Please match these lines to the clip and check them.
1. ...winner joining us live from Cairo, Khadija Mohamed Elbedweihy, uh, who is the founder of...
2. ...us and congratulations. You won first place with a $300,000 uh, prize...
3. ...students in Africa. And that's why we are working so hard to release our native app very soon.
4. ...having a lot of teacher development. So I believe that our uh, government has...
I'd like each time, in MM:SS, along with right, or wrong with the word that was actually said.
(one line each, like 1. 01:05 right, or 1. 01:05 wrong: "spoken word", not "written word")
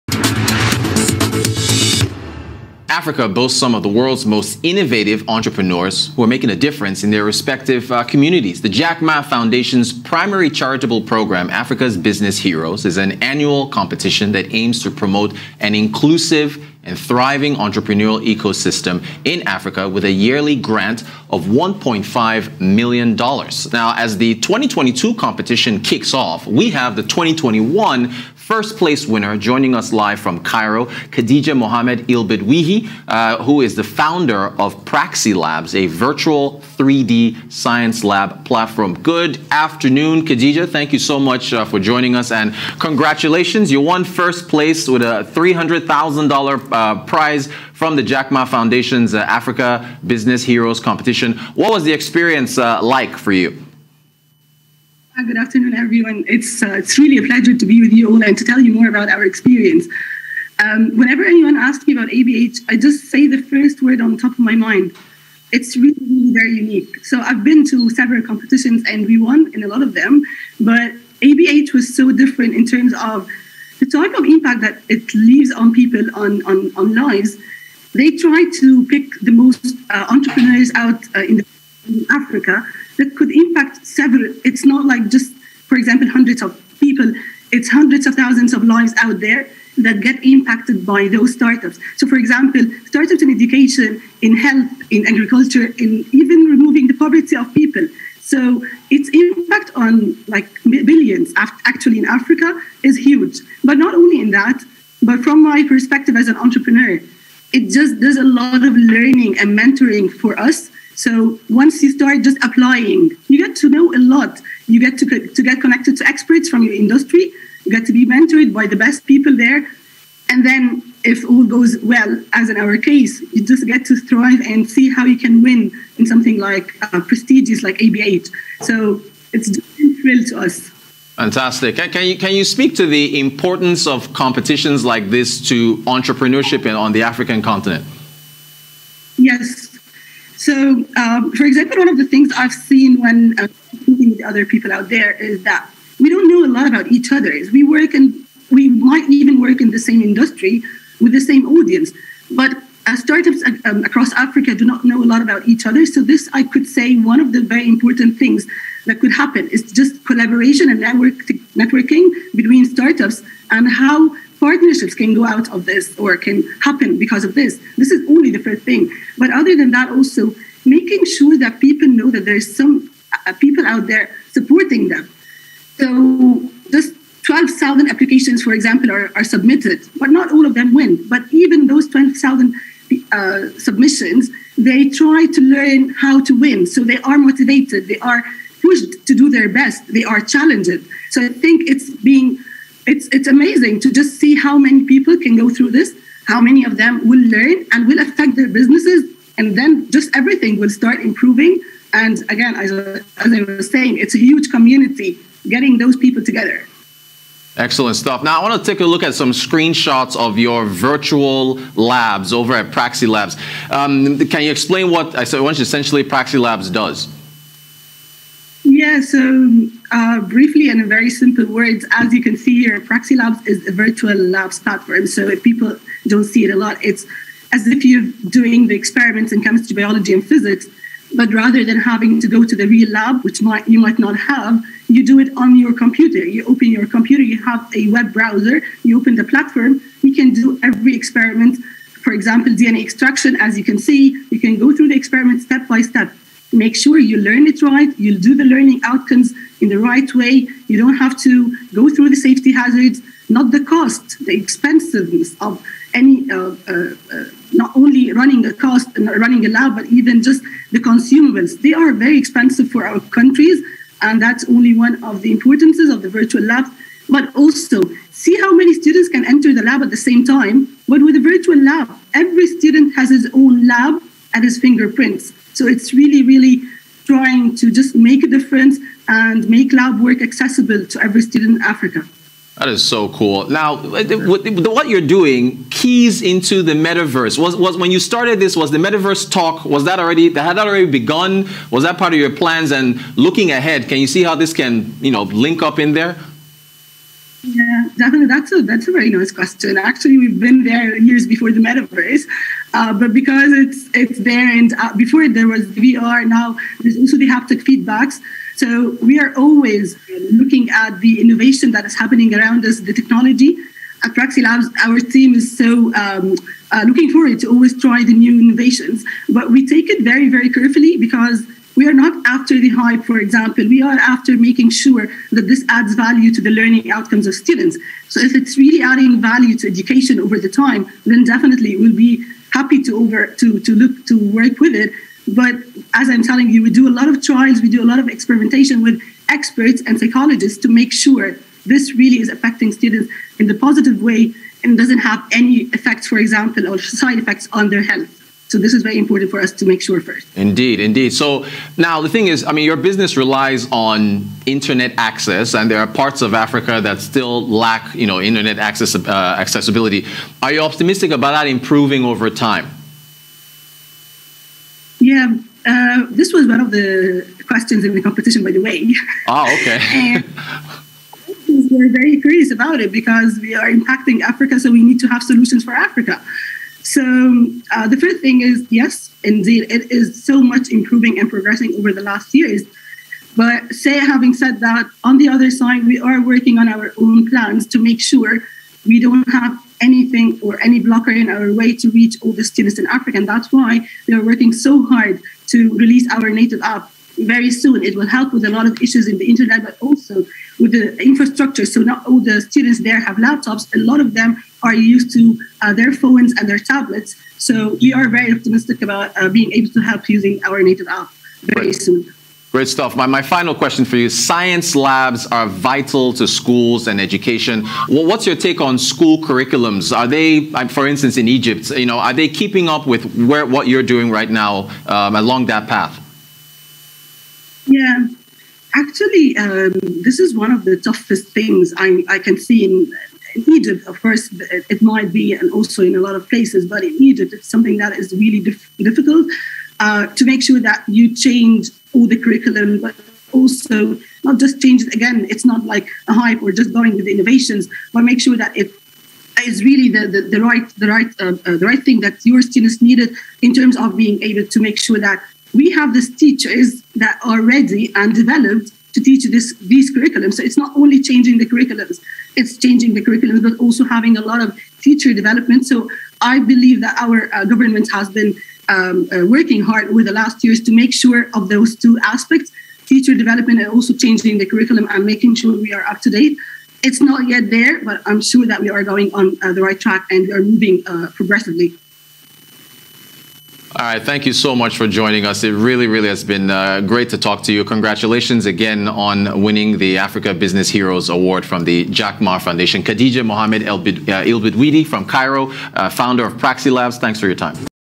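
1. 00:29 right
2. 00:42 right
3. 06:32 right
4. 07:43 right.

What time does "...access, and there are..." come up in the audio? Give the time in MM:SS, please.
05:54.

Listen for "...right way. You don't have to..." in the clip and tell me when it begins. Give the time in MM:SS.
04:09.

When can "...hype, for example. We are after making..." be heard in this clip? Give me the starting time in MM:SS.
05:22.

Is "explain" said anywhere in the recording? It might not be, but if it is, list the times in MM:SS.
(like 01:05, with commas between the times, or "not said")
03:34.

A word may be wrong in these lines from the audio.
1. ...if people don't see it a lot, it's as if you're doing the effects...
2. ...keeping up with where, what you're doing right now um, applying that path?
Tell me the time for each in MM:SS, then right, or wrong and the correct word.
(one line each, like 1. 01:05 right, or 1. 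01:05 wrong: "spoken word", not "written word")
1. 03:45 wrong: "experiments", not "effects"
2. 07:02 wrong: "along", not "applying".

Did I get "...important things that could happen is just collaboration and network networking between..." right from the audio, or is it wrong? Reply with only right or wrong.
right.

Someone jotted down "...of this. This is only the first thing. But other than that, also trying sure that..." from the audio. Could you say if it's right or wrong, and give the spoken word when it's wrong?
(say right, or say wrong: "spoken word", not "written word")
wrong: "making", not "trying".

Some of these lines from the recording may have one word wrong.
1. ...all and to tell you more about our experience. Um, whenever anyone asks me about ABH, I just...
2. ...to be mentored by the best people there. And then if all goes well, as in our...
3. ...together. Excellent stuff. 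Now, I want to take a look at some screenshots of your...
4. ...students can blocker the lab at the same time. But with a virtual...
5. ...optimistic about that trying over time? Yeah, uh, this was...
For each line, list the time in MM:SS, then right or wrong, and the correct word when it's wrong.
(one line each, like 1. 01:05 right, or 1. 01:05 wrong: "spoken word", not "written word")
1. 00:58 right
2. 01:57 right
3. 03:26 right
4. 04:28 wrong: "enter", not "blocker"
5. 06:00 wrong: "improving", not "trying".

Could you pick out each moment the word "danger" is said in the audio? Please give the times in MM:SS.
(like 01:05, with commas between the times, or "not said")
not said.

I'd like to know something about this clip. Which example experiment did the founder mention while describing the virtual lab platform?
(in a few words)
DNA extraction.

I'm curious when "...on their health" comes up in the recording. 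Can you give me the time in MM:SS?
05:47.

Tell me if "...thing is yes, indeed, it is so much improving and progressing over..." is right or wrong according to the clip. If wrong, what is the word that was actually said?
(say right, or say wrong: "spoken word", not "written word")
right.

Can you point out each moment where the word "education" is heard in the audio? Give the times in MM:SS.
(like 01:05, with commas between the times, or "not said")
01:33, 05:29, 06:56.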